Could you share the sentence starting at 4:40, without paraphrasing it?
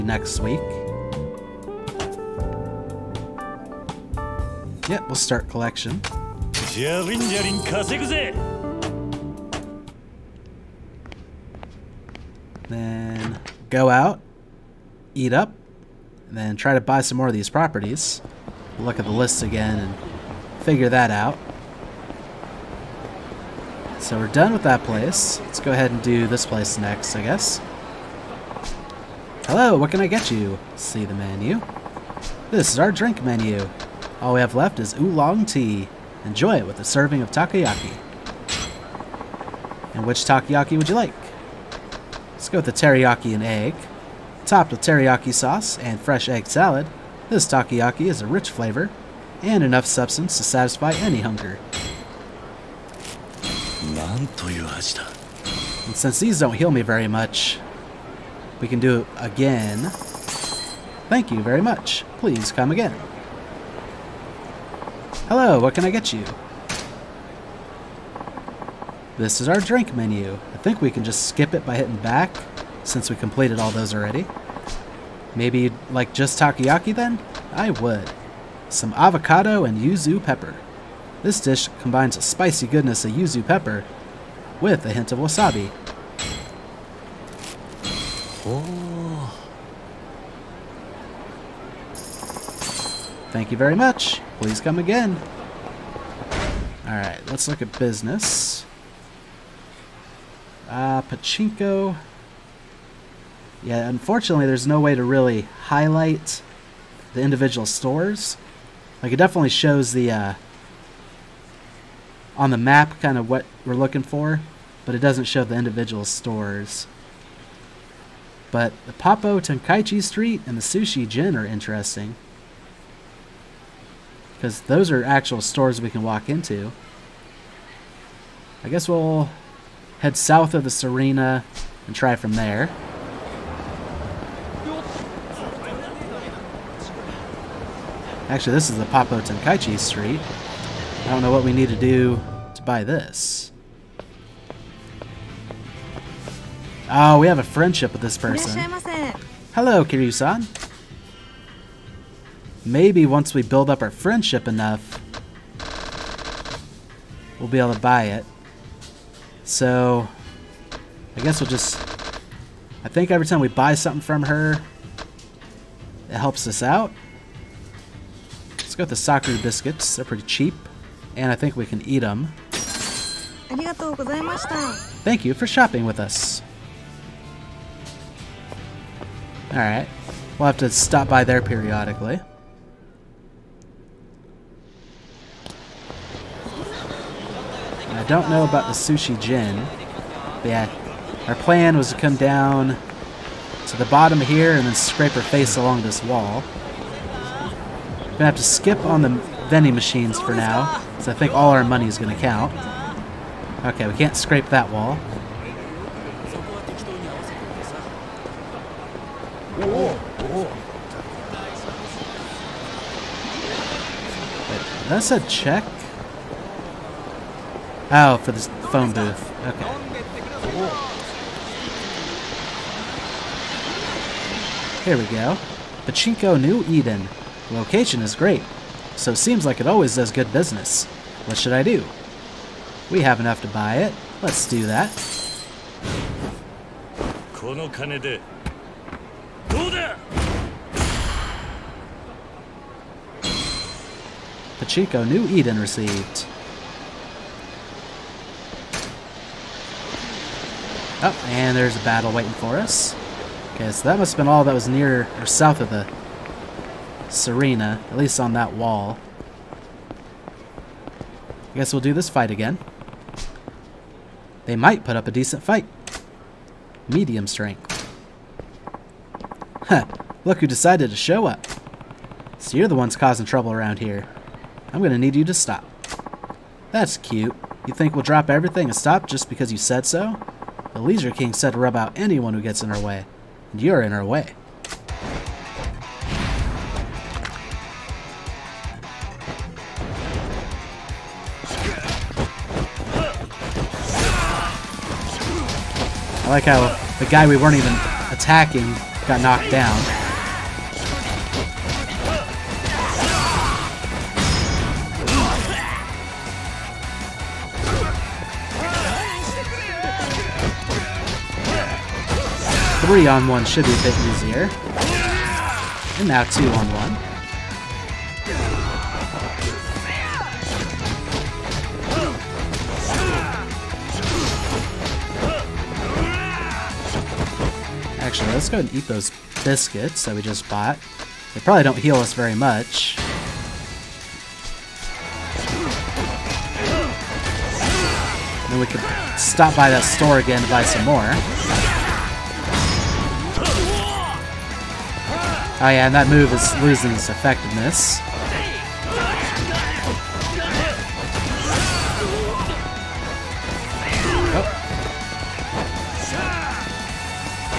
The Leisure King said to rub out anyone who gets in her way.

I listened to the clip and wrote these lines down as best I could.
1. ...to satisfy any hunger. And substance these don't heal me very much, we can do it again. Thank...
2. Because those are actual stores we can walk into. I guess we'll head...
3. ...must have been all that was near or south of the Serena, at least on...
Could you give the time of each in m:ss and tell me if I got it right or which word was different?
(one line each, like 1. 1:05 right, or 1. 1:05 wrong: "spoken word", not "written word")
1. 0:50 wrong: "since", not "substance"
2. 2:04 right
3. 4:13 right.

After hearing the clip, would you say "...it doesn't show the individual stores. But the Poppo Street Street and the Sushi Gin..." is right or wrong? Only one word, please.
wrong.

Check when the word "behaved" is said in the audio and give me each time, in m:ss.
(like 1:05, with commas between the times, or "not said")
not said.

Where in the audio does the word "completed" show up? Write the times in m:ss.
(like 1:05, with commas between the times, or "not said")
1:13.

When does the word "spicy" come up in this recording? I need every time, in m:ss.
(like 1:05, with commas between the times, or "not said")
1:22.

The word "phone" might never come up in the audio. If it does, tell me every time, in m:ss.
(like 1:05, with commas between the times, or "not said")
3:38.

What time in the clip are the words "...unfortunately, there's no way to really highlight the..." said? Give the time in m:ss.
1:43.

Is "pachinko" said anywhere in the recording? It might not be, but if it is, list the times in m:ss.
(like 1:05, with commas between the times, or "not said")
1:41, 3:45, 4:04.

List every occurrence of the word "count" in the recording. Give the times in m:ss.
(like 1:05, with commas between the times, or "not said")
3:22.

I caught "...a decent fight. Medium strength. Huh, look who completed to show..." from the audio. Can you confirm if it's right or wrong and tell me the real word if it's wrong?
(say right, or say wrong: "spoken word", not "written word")
wrong: "decided", not "completed".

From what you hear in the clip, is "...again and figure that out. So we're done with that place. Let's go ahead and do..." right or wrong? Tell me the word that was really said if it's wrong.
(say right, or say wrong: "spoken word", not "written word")
right.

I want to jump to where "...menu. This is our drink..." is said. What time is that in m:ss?
0:31.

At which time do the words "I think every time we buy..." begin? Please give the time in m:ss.
2:42.